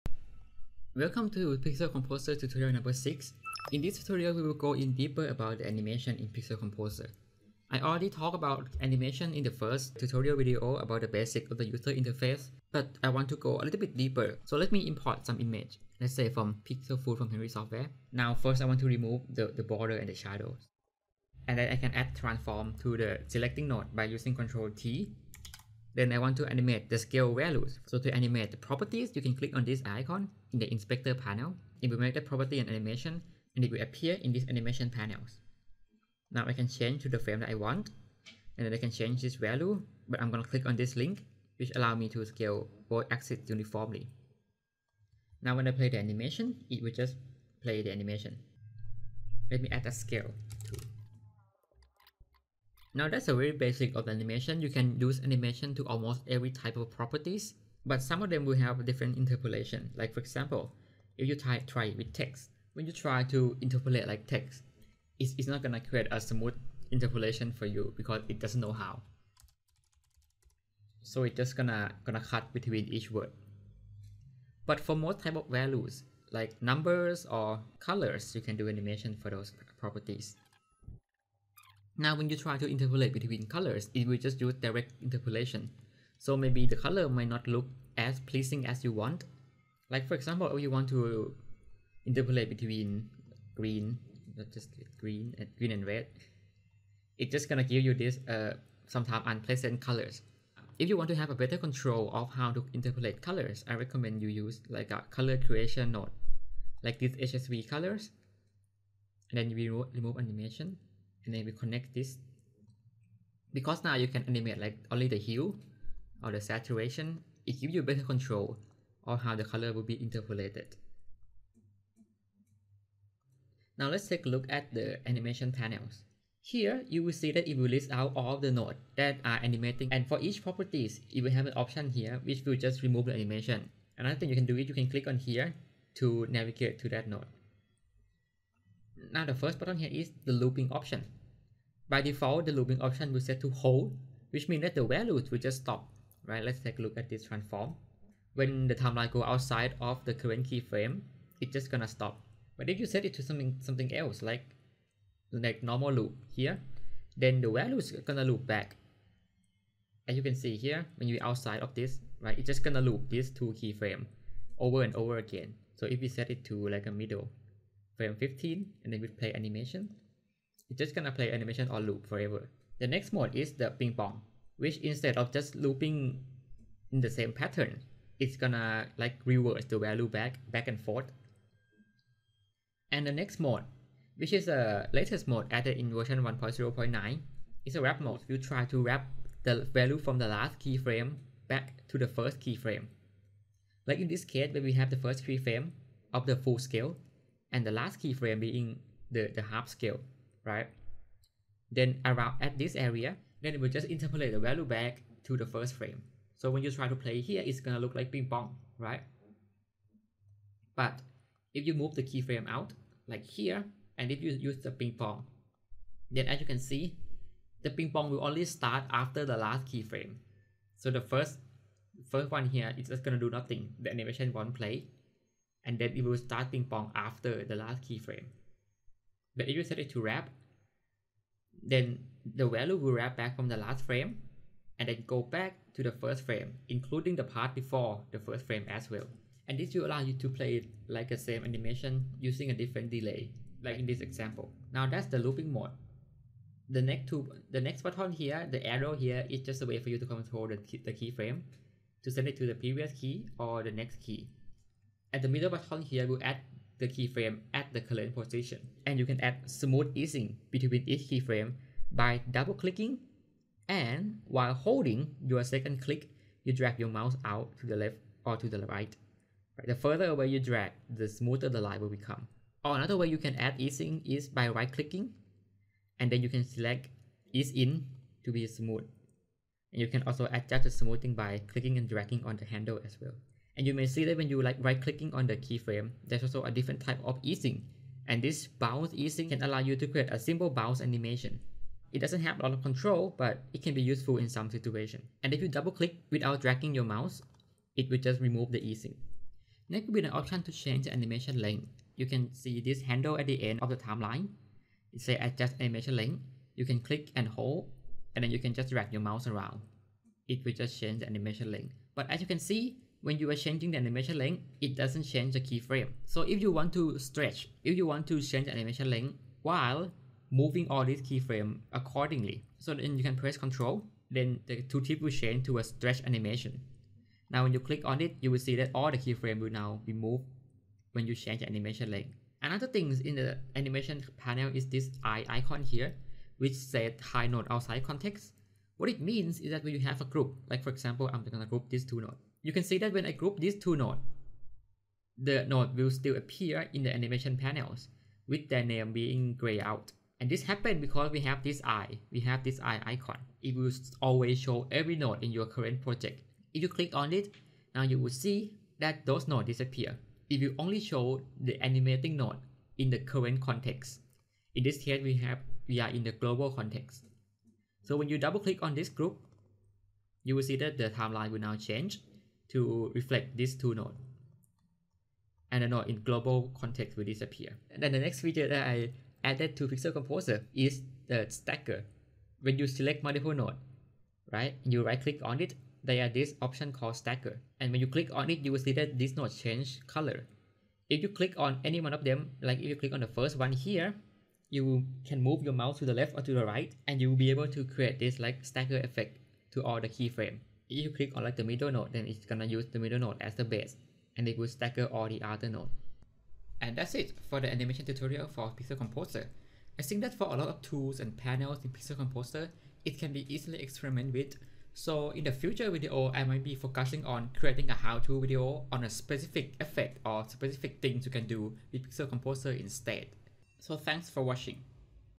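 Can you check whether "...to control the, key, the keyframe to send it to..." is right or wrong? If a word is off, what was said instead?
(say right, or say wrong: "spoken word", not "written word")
right.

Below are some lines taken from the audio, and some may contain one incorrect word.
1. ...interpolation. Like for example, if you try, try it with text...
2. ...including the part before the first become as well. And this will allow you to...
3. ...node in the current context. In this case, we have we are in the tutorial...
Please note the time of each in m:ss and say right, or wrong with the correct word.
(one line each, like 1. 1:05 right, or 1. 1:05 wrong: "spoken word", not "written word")
1. 0:59 right
2. 3:56 wrong: "frame", not "become"
3. 6:02 wrong: "global", not "tutorial".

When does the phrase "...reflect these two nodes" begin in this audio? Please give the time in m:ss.
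6:12.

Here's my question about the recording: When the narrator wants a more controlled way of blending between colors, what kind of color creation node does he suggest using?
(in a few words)
HSV colors.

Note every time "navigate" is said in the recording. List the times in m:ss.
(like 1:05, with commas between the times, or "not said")
2:16.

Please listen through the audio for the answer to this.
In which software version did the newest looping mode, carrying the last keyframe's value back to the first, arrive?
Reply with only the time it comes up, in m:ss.
3:06.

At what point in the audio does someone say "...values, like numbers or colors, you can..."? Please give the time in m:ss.
1:15.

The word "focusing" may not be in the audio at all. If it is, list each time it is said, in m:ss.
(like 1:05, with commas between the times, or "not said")
6:56.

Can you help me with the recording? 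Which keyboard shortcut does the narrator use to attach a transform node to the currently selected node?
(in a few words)
Ctrl T.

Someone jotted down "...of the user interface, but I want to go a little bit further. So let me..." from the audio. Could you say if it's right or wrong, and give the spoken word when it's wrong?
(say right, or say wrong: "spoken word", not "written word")
wrong: "deeper", not "further".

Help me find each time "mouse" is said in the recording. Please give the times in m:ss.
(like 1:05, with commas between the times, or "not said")
4:26, 4:56, 5:09, 6:35.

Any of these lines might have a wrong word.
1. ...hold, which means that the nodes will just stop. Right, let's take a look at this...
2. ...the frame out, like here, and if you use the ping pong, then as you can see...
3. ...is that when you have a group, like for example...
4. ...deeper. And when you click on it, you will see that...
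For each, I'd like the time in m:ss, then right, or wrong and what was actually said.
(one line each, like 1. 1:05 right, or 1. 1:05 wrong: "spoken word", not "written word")
1. 2:23 wrong: "values", not "nodes"
2. 3:31 wrong: "keyframe", not "frame"
3. 5:39 right
4. 6:26 wrong: "stagger", not "deeper".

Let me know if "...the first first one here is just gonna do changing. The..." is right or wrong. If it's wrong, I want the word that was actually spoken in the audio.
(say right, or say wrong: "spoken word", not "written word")
wrong: "nothing", not "changing".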